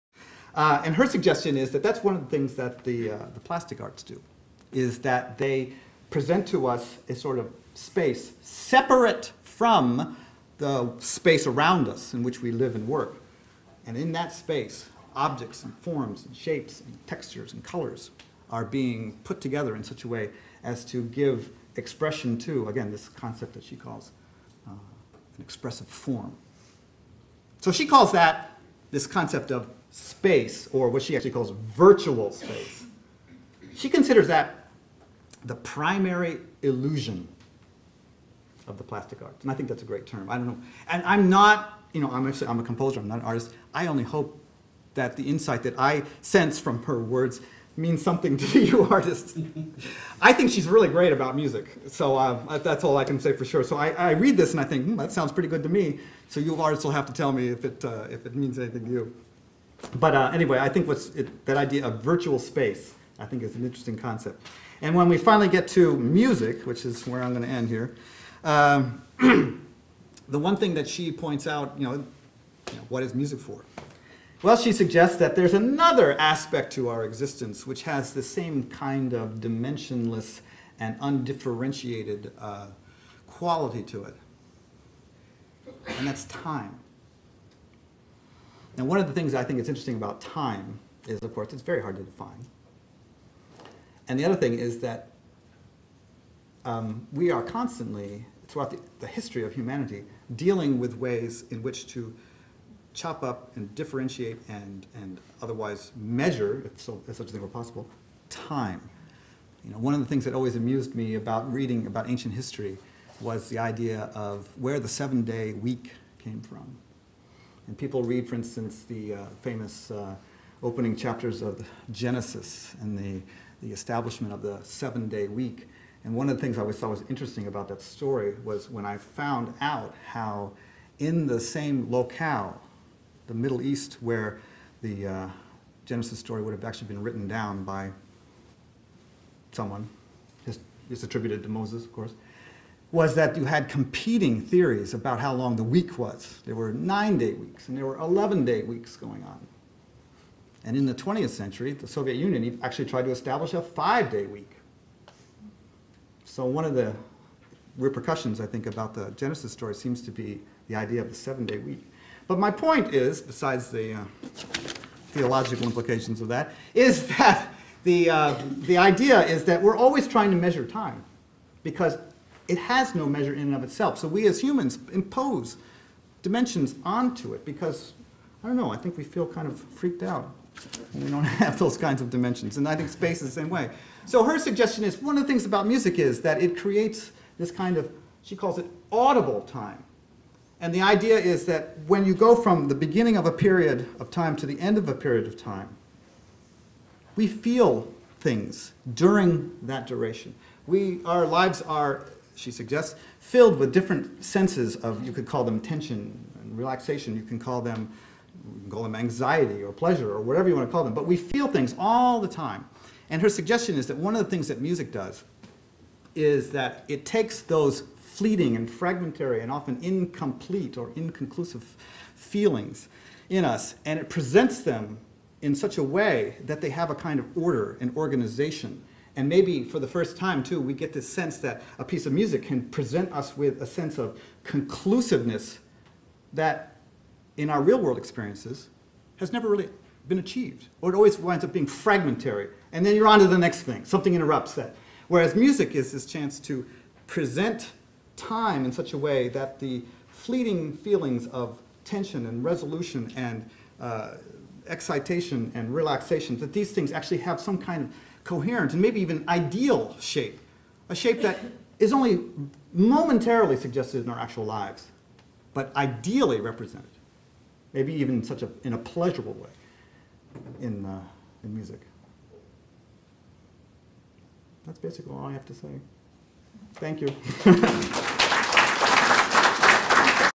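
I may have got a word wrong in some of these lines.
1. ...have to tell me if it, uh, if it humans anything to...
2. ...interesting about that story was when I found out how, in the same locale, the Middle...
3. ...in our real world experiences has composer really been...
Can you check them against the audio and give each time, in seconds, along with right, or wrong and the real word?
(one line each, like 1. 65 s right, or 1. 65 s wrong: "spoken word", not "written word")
1. 56 s wrong: "means", not "humans"
2. 127 s right
3. 237 s wrong: "never", not "composer".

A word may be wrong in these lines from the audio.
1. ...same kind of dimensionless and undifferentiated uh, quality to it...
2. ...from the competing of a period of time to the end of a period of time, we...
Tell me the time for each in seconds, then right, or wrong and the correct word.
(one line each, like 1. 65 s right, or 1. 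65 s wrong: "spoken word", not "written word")
1. 78 s right
2. 192 s wrong: "beginning", not "competing".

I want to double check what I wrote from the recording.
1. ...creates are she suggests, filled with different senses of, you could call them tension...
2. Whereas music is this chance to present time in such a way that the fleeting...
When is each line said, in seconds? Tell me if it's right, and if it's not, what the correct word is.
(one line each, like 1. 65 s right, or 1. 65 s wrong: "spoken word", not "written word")
1. 201 s wrong: "lives", not "creates"
2. 245 s right.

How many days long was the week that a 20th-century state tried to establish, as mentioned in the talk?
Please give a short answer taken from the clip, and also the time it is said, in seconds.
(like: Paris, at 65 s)
5, at 153 s.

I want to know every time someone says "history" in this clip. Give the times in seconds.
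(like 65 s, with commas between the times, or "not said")
99 s, 112 s.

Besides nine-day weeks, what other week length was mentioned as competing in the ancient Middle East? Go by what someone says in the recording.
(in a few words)
11-day weeks.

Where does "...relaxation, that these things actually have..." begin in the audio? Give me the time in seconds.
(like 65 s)
255 s.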